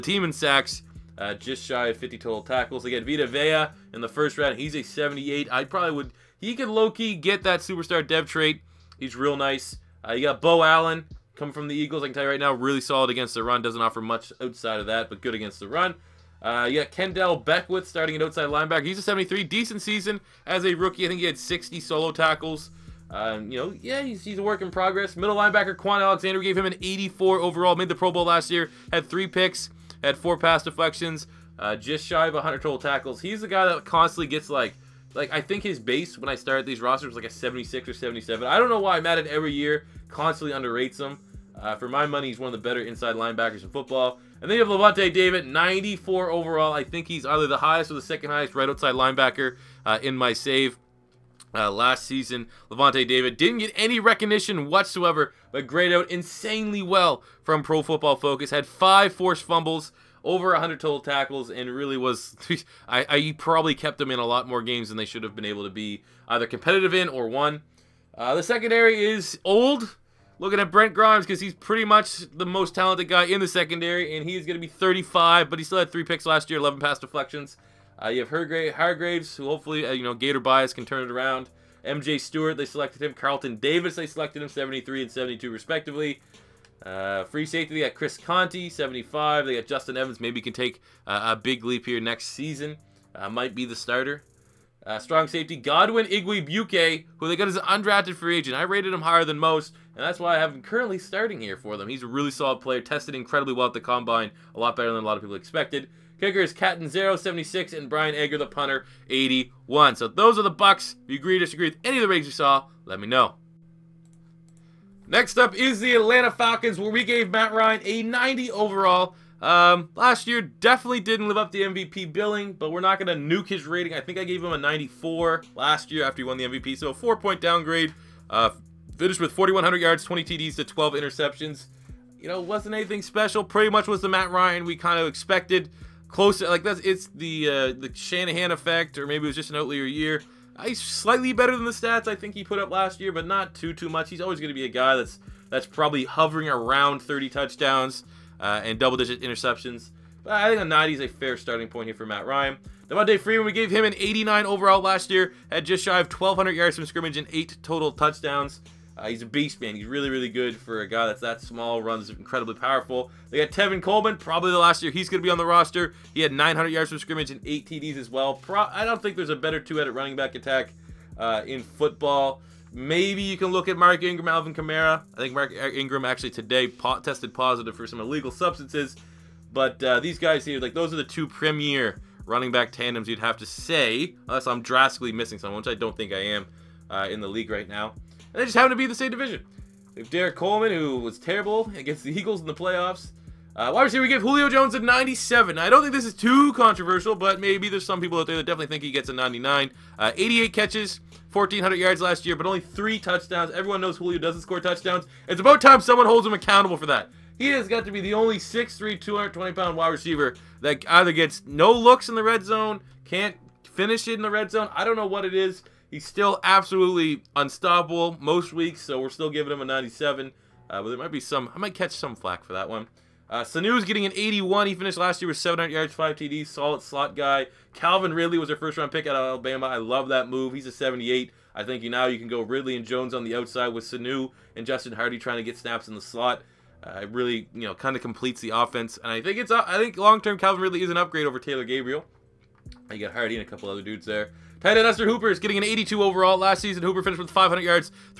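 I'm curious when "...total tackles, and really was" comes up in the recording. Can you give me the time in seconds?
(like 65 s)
60 s.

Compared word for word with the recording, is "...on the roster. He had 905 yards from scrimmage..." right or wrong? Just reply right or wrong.
wrong.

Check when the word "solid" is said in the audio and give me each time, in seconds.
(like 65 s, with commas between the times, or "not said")
12 s, 102 s, 226 s.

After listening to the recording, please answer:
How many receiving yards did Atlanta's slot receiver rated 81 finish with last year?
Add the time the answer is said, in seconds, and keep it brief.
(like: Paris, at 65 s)
700, at 225 s.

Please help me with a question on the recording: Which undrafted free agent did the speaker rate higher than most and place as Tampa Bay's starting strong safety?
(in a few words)
Godwin Igwebuike.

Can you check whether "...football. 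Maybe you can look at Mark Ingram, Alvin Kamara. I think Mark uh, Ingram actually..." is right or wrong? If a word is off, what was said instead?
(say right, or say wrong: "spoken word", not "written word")
right.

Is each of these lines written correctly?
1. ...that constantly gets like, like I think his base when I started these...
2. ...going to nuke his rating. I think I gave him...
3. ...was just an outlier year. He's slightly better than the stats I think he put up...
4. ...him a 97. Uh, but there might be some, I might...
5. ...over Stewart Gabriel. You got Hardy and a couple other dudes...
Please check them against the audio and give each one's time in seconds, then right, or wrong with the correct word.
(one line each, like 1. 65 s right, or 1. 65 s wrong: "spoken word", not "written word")
1. 33 s right
2. 123 s right
3. 139 s right
4. 219 s right
5. 241 s wrong: "Taylor", not "Stewart".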